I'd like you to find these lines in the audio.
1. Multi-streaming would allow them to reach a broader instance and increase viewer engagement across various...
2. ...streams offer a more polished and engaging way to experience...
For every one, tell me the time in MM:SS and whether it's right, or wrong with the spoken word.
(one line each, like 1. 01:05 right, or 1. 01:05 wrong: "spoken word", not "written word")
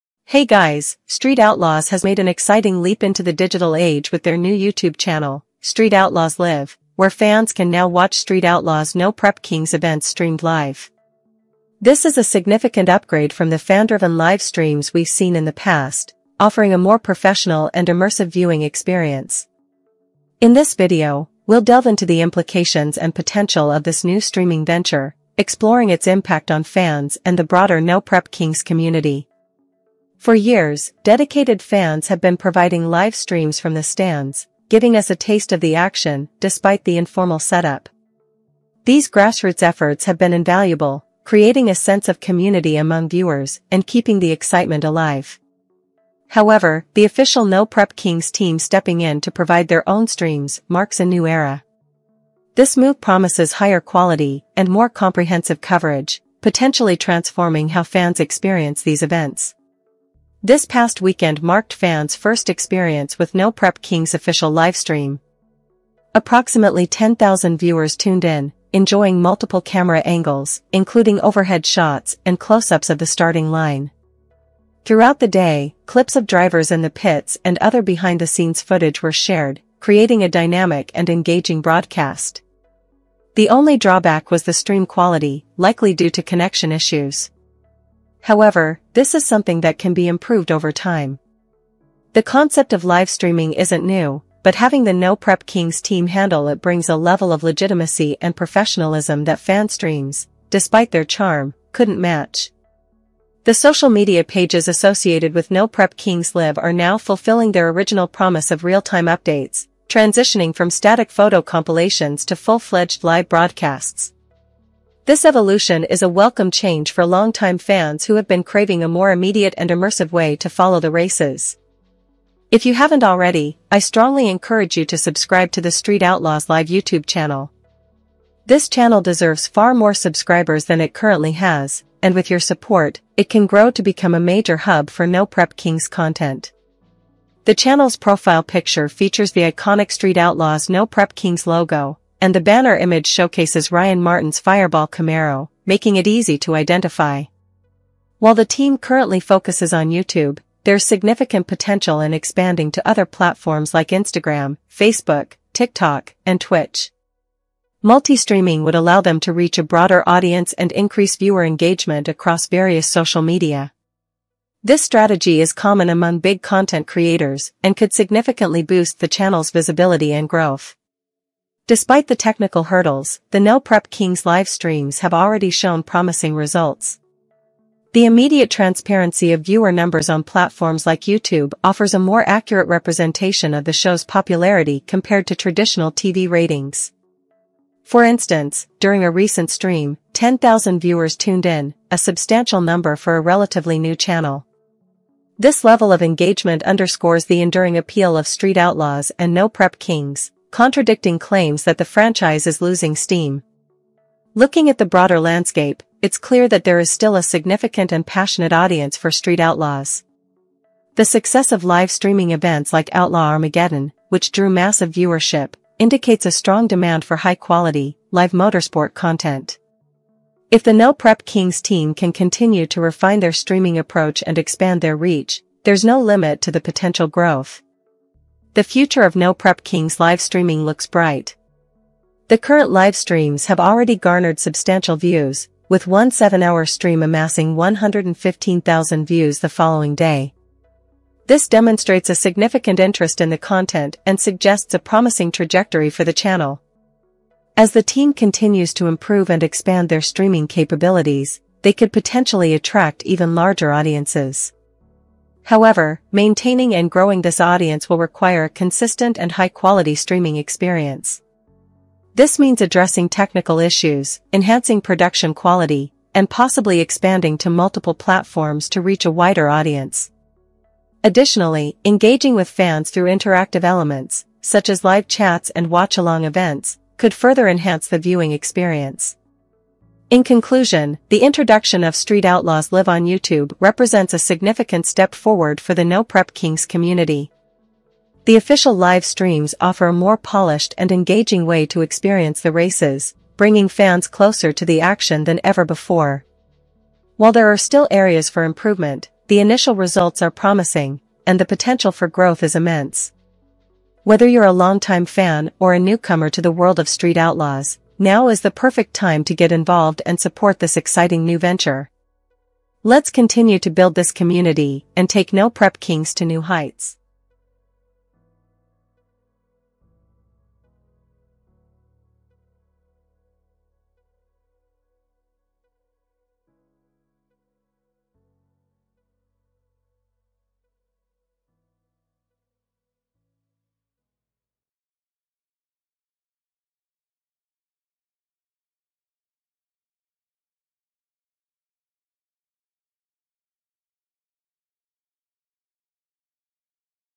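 1. 02:37 wrong: "audience", not "instance"
2. 04:49 right.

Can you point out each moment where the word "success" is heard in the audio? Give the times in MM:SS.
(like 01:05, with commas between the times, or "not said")
03:31.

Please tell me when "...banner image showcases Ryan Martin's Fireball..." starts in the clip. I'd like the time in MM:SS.
02:22.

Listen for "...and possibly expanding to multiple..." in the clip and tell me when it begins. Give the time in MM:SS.
04:26.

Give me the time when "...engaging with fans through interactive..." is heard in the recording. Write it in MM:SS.
04:31.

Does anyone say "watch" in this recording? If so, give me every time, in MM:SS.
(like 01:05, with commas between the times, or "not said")
00:07, 04:35.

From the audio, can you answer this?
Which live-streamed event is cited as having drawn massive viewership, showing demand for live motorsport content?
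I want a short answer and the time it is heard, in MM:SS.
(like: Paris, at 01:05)
Outlaw Armageddon, at 03:32.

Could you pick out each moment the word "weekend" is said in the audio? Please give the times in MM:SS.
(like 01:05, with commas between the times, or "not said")
01:01.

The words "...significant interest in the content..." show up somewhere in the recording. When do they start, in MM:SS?
04:02.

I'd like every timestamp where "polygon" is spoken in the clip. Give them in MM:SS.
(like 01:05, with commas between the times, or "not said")
not said.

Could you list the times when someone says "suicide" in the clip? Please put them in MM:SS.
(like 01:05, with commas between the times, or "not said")
not said.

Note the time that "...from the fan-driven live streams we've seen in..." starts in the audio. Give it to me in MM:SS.
00:13.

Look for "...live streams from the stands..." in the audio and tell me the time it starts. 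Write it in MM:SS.
00:32.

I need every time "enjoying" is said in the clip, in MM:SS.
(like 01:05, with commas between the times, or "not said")
01:08.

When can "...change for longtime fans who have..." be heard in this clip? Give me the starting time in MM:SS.
01:56.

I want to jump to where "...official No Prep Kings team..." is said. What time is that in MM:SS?
00:47.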